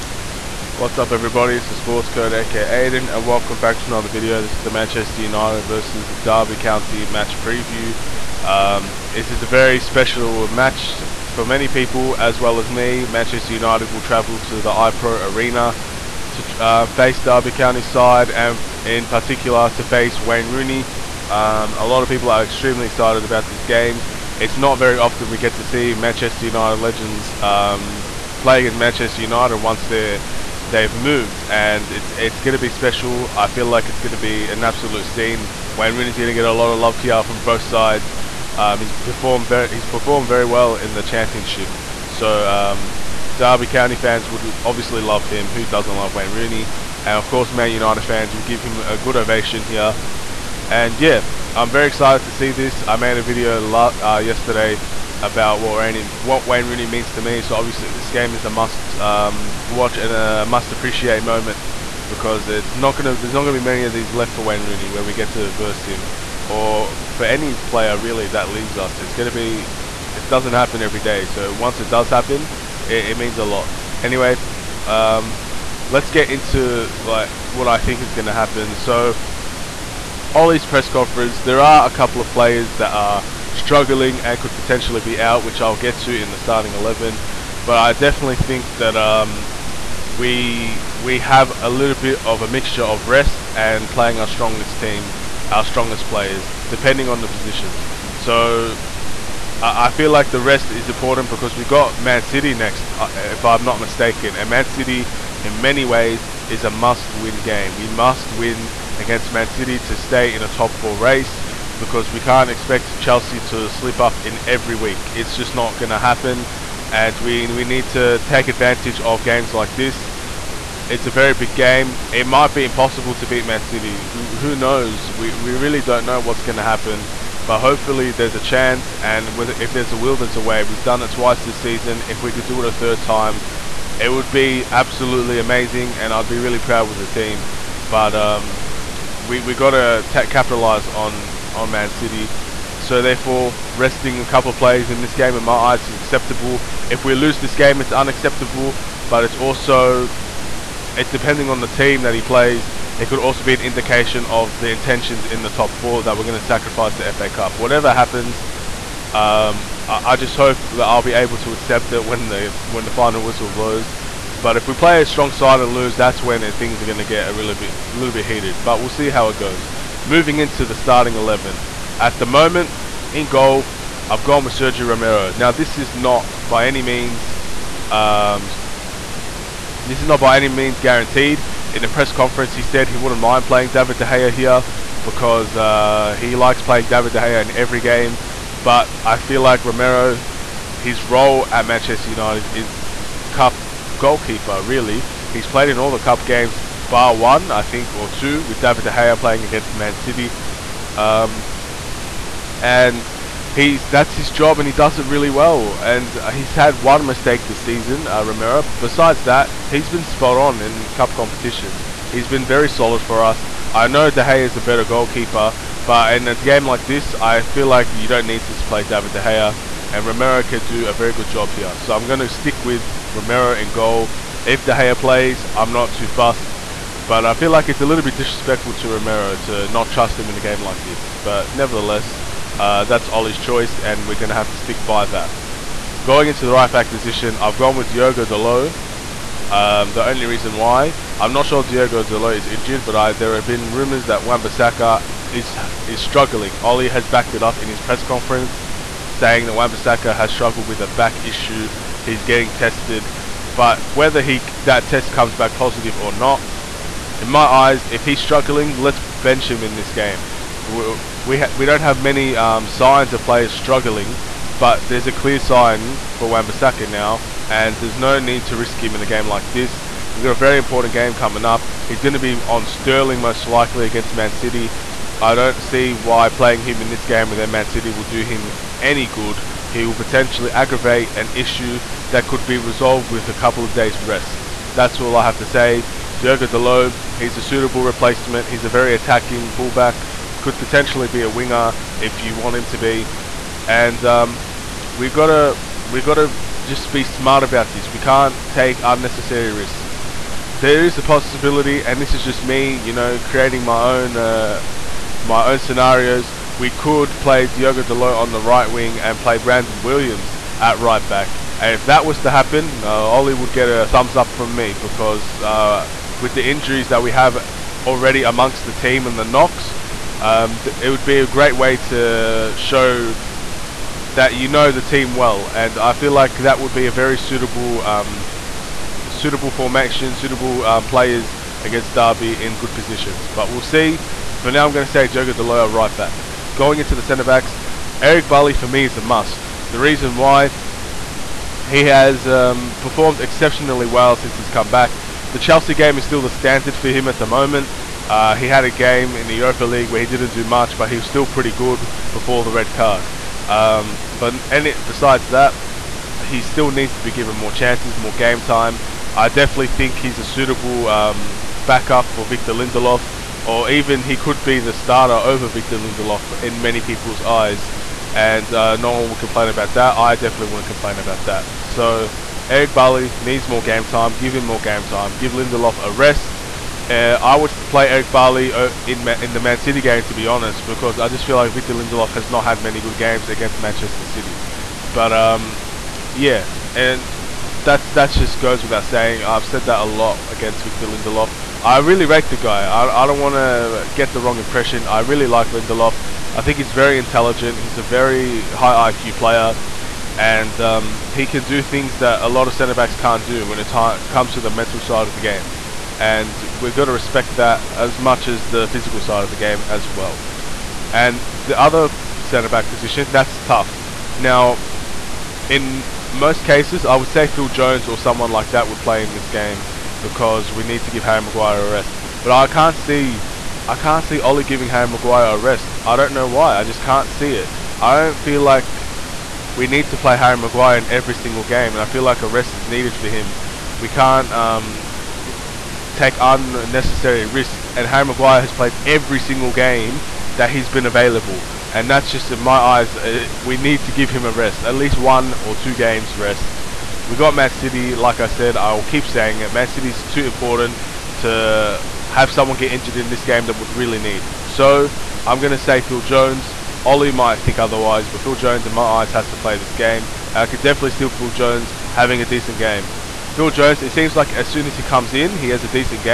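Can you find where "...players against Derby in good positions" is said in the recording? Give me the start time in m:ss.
5:30.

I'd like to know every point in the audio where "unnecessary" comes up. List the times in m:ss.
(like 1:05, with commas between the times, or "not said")
4:58, 7:16.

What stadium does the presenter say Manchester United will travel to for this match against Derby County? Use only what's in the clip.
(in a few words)
iPro Arena.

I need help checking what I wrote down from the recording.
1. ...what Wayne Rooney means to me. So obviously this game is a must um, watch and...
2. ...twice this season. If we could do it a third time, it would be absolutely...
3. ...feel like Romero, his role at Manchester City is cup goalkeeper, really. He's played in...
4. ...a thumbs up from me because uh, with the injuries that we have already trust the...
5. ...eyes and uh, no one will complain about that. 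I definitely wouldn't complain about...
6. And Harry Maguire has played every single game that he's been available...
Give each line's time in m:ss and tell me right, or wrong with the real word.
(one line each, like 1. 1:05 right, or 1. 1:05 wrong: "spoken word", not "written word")
1. 0:56 right
2. 2:11 right
3. 3:09 wrong: "United", not "City"
4. 5:13 wrong: "amongst", not "trust"
5. 6:07 right
6. 7:17 right.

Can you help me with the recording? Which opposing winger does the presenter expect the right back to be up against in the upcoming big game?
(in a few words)
Sterling.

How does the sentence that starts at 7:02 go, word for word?
But I can't see, I can't see Ollie giving Harry Maguire a rest.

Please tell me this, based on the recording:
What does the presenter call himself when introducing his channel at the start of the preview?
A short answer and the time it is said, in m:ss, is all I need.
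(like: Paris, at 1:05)
the Sports Code, at 0:01.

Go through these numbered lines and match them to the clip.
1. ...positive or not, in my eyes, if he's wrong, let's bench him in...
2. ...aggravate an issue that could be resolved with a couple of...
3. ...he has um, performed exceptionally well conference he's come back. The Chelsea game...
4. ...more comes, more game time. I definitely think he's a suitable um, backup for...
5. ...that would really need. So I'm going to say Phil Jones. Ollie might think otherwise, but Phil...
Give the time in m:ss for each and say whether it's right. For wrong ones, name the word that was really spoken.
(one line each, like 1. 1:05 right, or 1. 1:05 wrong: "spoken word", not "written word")
1. 4:15 wrong: "struggling", not "wrong"
2. 4:40 right
3. 5:41 wrong: "since", not "conference"
4. 5:57 wrong: "chances", not "comes"
5. 7:33 right.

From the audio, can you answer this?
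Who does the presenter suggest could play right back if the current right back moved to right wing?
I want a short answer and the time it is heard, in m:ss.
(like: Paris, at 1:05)
Brandon Williams, at 5:09.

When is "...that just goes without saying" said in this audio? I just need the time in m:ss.
6:27.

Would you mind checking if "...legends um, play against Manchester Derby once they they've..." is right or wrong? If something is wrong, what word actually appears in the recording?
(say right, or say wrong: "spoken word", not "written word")
wrong: "United", not "Derby".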